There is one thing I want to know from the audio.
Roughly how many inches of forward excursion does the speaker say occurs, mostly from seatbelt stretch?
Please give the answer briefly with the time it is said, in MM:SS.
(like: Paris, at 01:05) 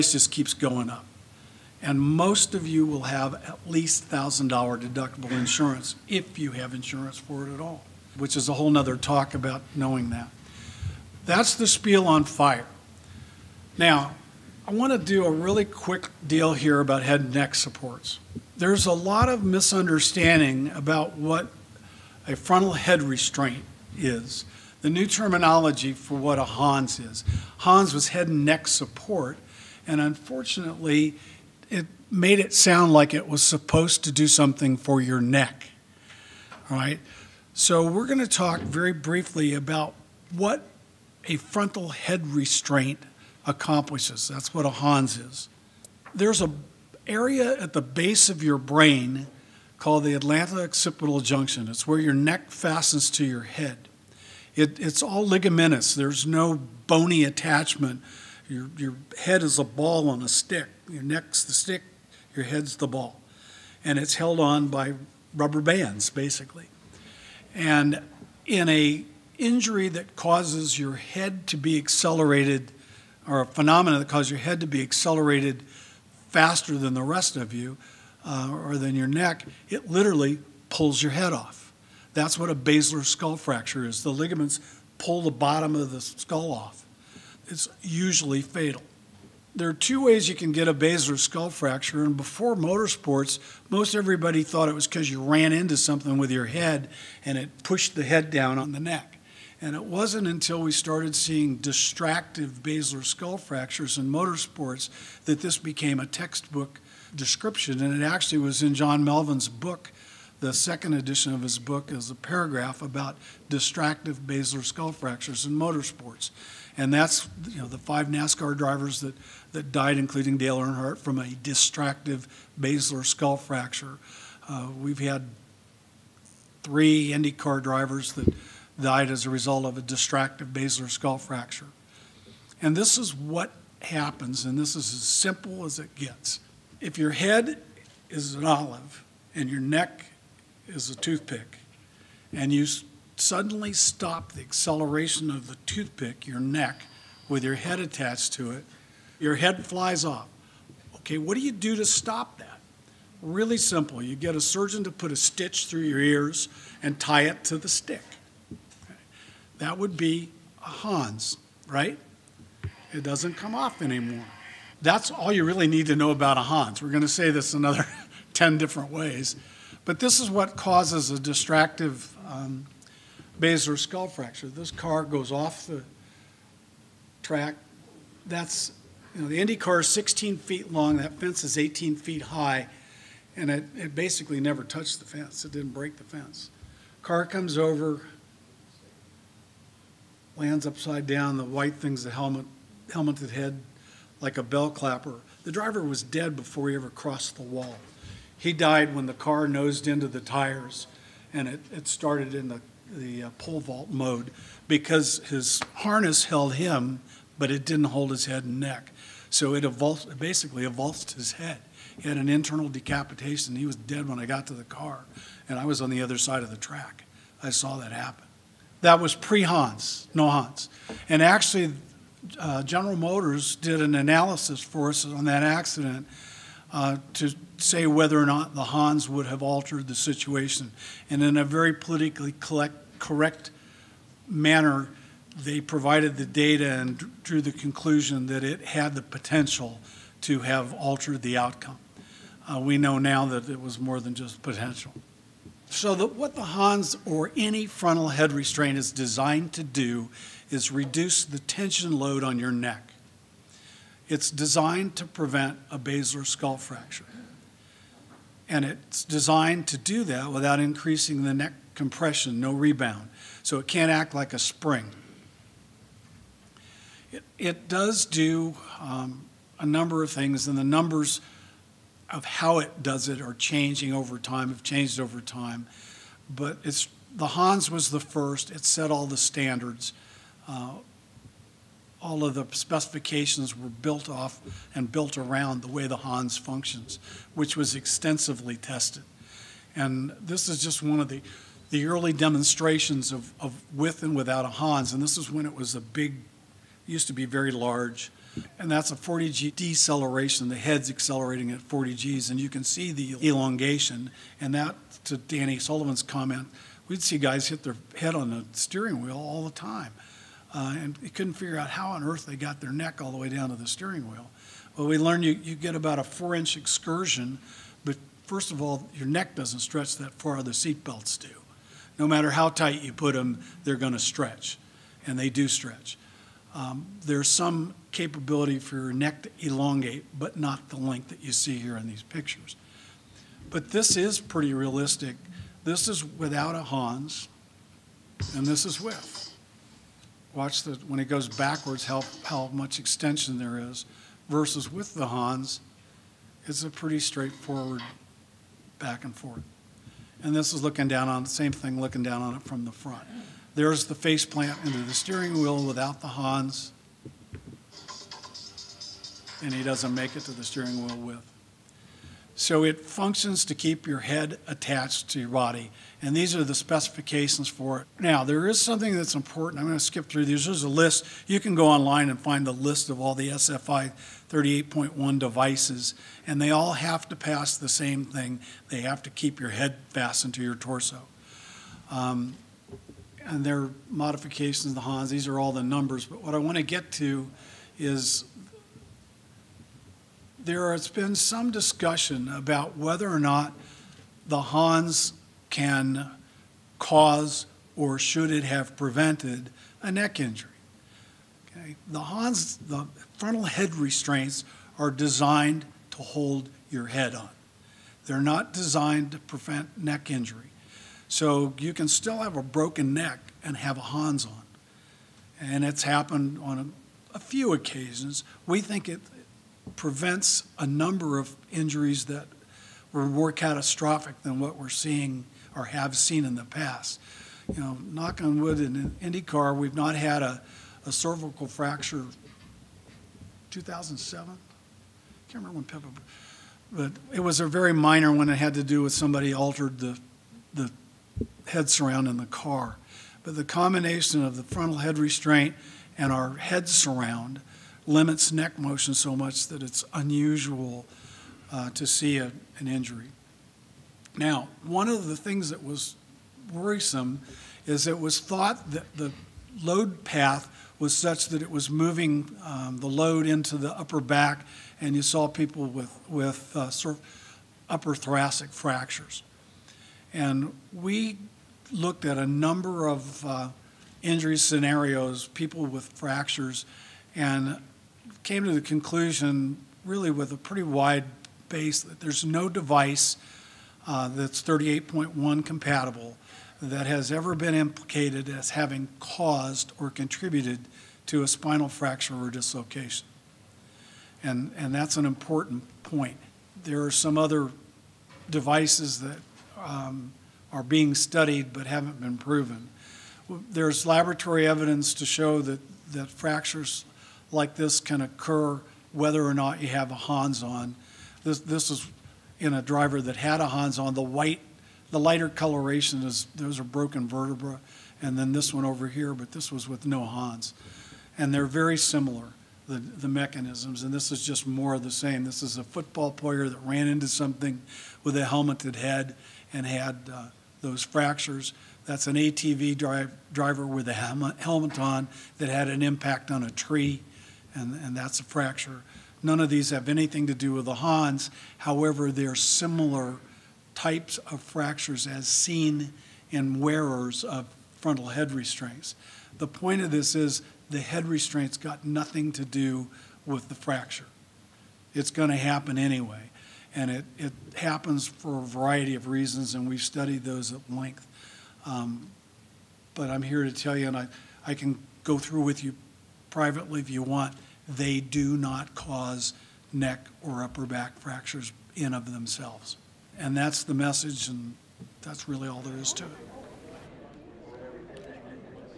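4 inches, at 05:16.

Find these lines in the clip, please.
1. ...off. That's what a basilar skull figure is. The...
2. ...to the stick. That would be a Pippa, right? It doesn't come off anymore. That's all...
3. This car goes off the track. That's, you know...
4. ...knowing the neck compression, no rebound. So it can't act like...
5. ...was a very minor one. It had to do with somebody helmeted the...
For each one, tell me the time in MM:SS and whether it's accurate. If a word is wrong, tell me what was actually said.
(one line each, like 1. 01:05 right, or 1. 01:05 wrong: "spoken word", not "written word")
1. 01:21 wrong: "fracture", not "figure"
2. 02:37 wrong: "Hans", not "Pippa"
3. 02:54 right
4. 04:20 wrong: "increasing", not "knowing"
5. 07:17 wrong: "altered", not "helmeted".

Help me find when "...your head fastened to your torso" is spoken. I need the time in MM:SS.
06:19.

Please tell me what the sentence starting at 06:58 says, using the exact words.
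We think it prevents a number of injuries that were more catastrophic than what we're seeing or have seen in the past.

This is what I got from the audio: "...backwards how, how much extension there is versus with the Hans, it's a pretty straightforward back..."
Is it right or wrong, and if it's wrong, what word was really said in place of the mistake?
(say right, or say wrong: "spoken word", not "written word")
right.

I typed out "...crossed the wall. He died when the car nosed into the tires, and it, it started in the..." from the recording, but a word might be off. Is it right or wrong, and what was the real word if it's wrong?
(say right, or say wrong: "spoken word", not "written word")
right.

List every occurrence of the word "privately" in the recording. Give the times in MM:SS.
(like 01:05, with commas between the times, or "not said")
09:26.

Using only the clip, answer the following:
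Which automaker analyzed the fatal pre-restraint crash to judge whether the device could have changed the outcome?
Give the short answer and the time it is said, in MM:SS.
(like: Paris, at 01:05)
General Motors, at 03:42.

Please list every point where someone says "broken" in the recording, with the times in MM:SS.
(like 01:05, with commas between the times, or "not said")
06:52, 08:36.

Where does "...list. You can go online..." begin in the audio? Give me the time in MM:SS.
06:10.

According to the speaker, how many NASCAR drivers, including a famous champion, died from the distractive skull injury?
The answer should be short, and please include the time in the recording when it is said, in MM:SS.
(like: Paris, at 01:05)
5, at 01:57.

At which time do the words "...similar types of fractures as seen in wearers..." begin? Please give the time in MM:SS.
09:02.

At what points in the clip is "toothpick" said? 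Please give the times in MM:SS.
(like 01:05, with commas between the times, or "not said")
02:20, 02:25.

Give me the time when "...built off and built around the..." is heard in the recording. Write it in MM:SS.
04:43.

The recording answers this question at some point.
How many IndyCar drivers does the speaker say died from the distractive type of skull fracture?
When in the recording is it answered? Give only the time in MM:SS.
02:06.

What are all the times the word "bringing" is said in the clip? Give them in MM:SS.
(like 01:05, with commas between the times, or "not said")
not said.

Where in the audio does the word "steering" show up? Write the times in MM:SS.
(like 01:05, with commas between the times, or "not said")
05:08, 05:13, 05:54, 06:00.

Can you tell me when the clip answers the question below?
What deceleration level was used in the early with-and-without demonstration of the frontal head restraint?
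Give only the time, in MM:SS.
04:58.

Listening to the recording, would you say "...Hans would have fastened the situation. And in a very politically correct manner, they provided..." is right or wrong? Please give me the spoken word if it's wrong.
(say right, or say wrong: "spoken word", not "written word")
wrong: "altered", not "fastened".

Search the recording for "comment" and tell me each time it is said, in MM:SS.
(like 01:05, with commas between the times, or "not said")
05:06.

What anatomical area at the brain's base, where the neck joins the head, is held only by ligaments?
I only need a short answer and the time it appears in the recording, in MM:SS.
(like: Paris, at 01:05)
atlanto occipital junction, at 00:50.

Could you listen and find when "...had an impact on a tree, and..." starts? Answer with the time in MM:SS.
08:55.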